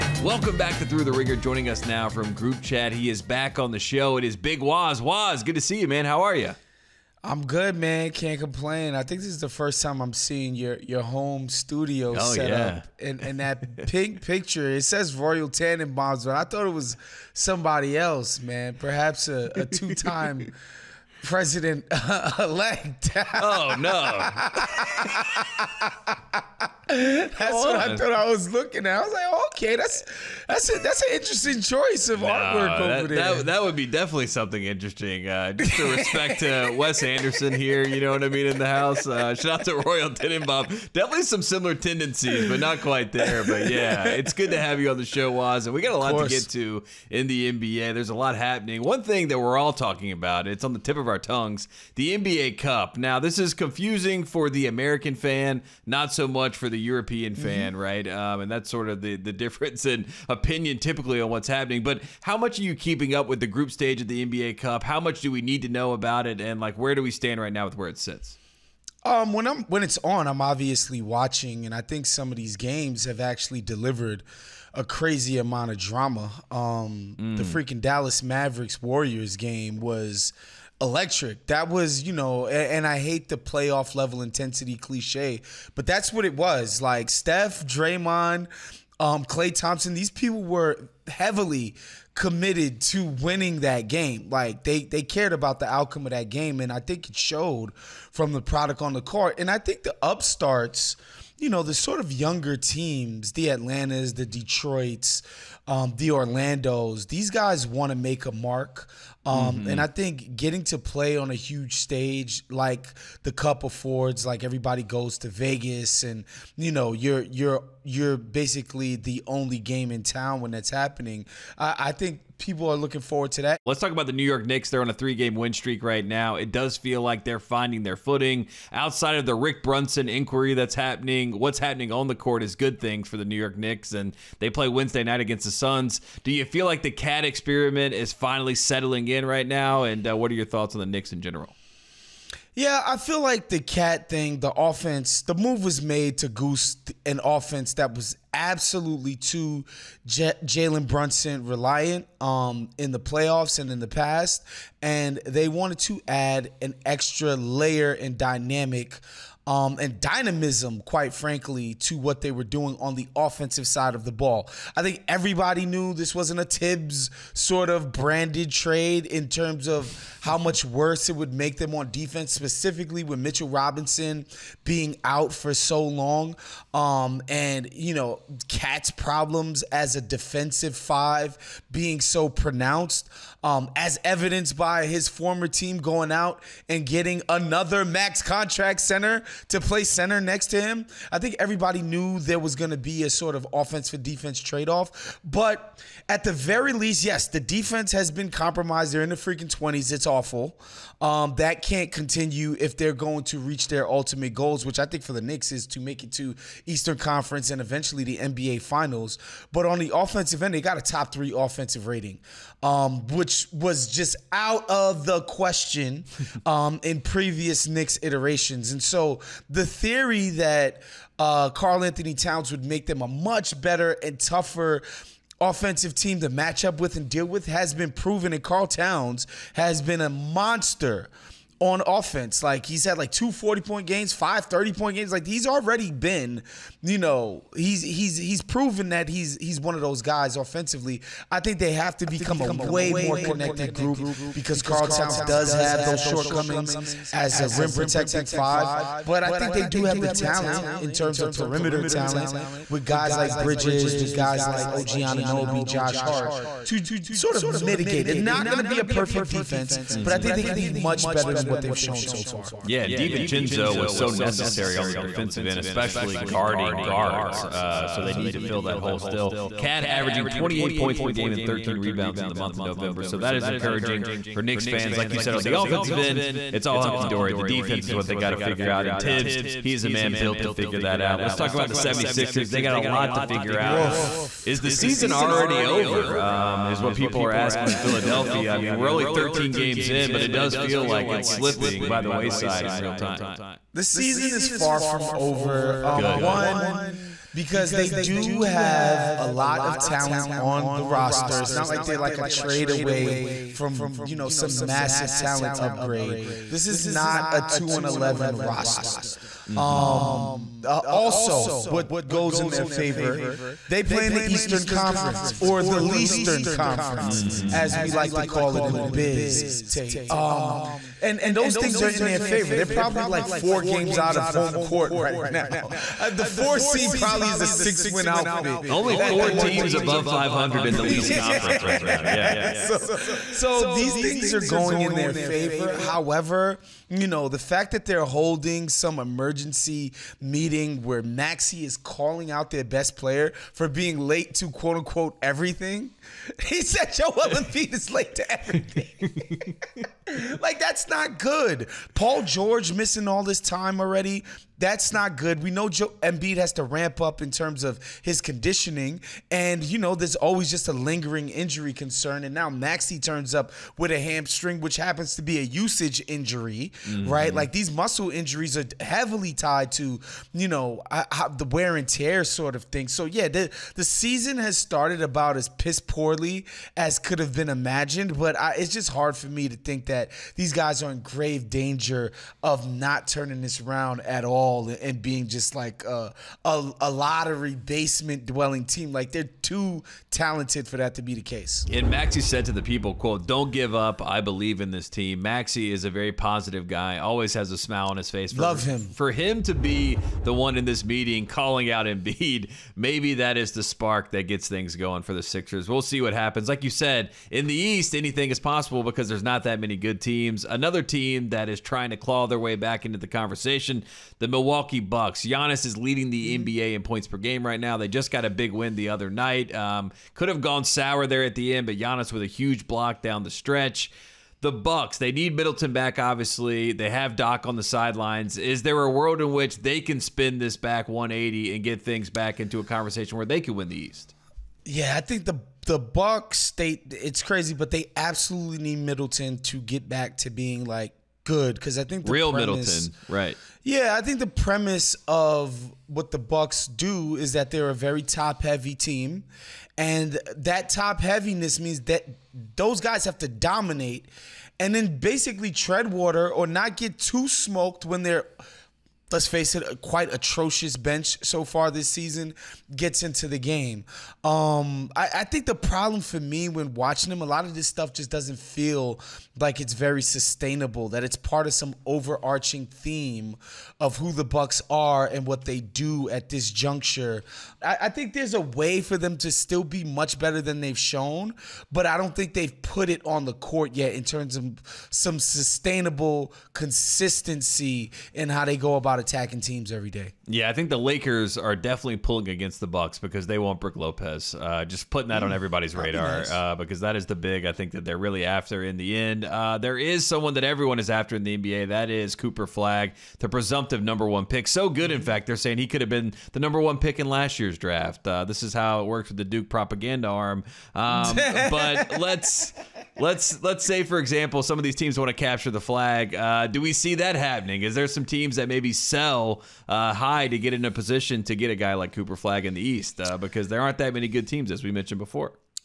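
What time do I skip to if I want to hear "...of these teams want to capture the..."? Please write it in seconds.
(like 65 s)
514 s.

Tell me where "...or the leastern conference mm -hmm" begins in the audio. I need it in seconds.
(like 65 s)
315 s.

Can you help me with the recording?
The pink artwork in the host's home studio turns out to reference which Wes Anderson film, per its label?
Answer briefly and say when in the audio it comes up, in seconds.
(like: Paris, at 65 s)
Royal Tenenbaums, at 15 s.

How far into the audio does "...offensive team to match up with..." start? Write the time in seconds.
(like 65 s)
225 s.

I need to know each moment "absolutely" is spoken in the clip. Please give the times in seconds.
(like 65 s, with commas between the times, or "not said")
148 s, 437 s.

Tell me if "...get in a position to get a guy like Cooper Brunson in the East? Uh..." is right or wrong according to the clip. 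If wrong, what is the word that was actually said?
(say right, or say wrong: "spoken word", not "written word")
wrong: "Flagg", not "Brunson".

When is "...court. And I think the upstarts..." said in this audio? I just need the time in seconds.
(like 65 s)
99 s.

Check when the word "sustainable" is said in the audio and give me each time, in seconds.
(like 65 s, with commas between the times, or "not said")
470 s, 485 s.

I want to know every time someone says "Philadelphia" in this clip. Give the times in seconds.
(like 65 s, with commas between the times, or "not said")
287 s.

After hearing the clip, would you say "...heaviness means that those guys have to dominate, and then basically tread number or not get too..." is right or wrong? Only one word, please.
wrong.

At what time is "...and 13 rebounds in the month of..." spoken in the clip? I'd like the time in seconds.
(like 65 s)
271 s.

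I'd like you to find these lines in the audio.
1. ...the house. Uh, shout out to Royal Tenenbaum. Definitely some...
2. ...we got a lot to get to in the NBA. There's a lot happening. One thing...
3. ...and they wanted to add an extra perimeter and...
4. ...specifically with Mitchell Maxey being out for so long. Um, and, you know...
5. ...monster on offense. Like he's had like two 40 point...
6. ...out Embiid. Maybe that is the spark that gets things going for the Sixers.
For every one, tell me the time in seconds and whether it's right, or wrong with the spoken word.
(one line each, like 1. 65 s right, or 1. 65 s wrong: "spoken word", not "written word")
1. 38 s right
2. 45 s right
3. 154 s wrong: "layer", not "perimeter"
4. 172 s wrong: "Robinson", not "Maxey"
5. 230 s right
6. 401 s right.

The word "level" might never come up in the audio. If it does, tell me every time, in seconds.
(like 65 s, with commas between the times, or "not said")
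83 s.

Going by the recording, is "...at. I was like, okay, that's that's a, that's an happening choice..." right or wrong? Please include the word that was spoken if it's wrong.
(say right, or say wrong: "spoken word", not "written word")
wrong: "interesting", not "happening".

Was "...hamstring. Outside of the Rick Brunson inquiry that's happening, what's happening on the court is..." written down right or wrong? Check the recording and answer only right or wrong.
wrong.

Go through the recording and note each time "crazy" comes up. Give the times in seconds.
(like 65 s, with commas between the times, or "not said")
74 s, 437 s.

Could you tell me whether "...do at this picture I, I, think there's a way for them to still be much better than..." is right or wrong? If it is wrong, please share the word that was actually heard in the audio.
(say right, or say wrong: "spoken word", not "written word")
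wrong: "juncture", not "picture".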